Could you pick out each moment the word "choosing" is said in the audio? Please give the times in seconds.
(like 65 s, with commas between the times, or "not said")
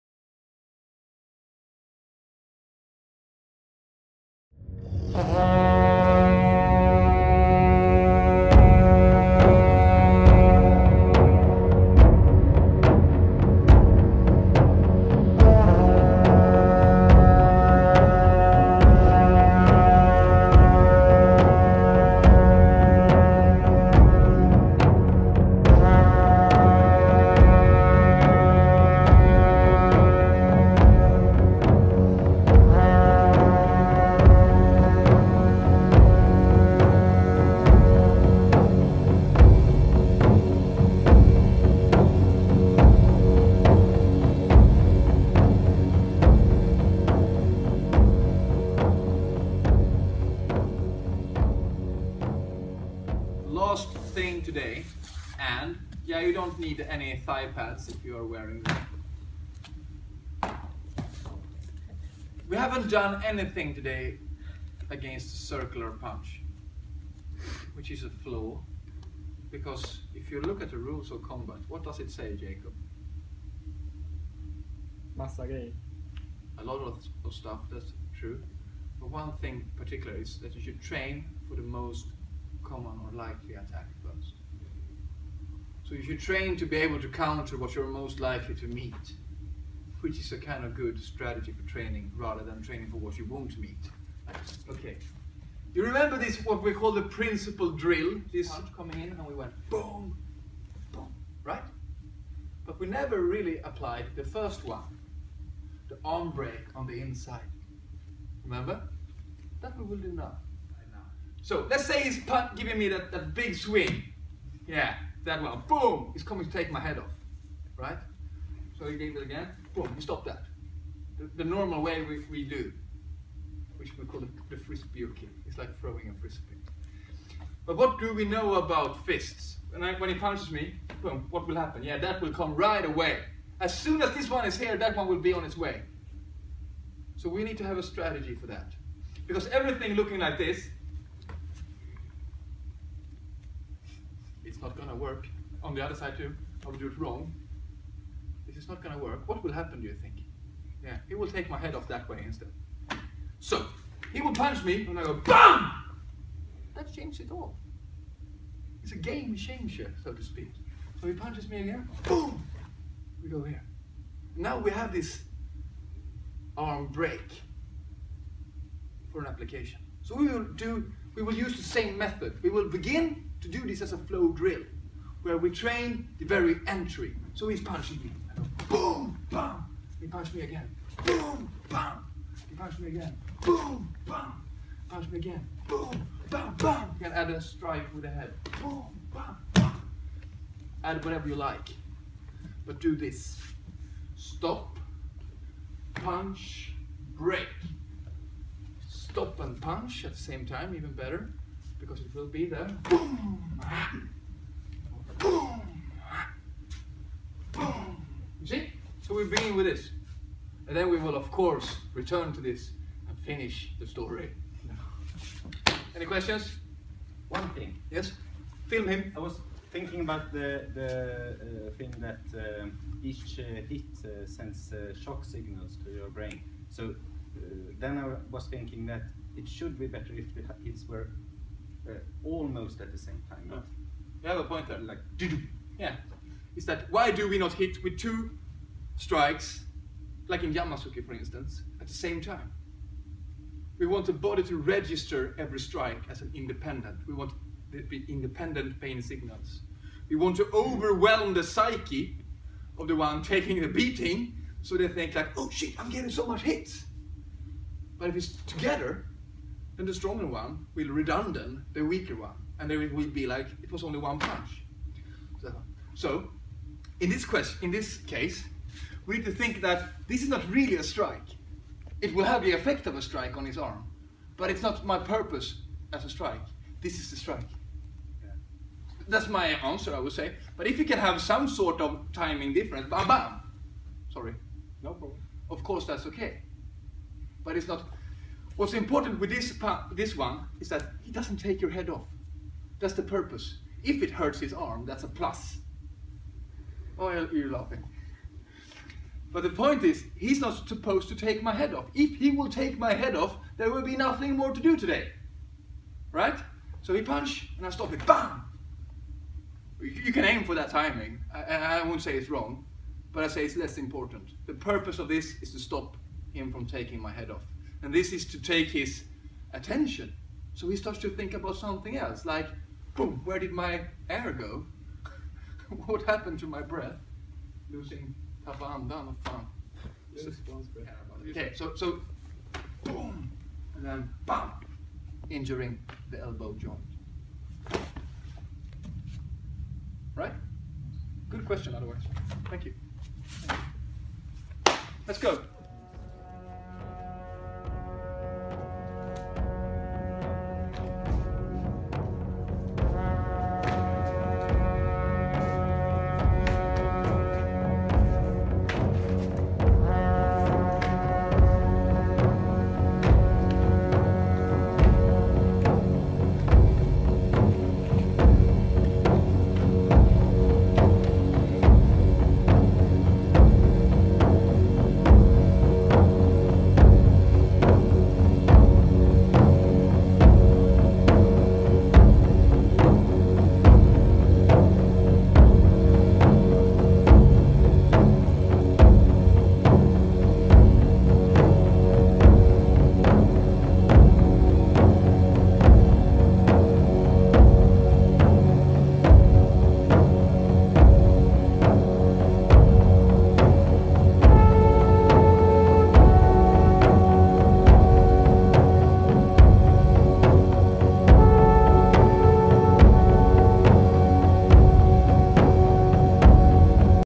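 not said.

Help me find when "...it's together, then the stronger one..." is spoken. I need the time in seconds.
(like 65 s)
258 s.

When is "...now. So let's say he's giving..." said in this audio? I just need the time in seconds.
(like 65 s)
110 s.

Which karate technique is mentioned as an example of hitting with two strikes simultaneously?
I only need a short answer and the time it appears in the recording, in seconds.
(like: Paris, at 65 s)
Yamazuki, at 240 s.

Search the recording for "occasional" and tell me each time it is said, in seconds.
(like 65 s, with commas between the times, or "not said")
not said.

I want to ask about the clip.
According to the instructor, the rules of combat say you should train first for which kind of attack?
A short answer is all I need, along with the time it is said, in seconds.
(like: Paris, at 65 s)
The most common or likely attack, at 81 s.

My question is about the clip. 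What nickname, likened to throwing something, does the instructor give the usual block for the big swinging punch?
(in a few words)
Frisbee kick.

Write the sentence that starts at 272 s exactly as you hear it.
It will have the effect of a strike on his arm, but it's not my purpose as a strike.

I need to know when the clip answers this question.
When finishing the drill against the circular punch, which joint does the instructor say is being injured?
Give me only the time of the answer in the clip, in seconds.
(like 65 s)
336 s.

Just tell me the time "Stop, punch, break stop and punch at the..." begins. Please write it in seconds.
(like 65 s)
194 s.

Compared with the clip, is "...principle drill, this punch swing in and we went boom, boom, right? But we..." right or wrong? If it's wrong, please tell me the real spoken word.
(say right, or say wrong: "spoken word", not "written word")
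wrong: "coming", not "swing".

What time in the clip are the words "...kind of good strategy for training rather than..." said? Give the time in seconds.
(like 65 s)
90 s.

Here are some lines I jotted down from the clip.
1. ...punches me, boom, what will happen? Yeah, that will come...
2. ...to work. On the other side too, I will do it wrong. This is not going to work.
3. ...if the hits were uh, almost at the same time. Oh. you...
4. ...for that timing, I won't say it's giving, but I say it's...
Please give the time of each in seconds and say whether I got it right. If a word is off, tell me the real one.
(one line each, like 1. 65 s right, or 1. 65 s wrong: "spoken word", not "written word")
1. 130 s right
2. 144 s right
3. 230 s right
4. 310 s wrong: "wrong", not "giving".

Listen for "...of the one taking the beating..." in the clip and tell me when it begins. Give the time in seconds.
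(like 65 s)
252 s.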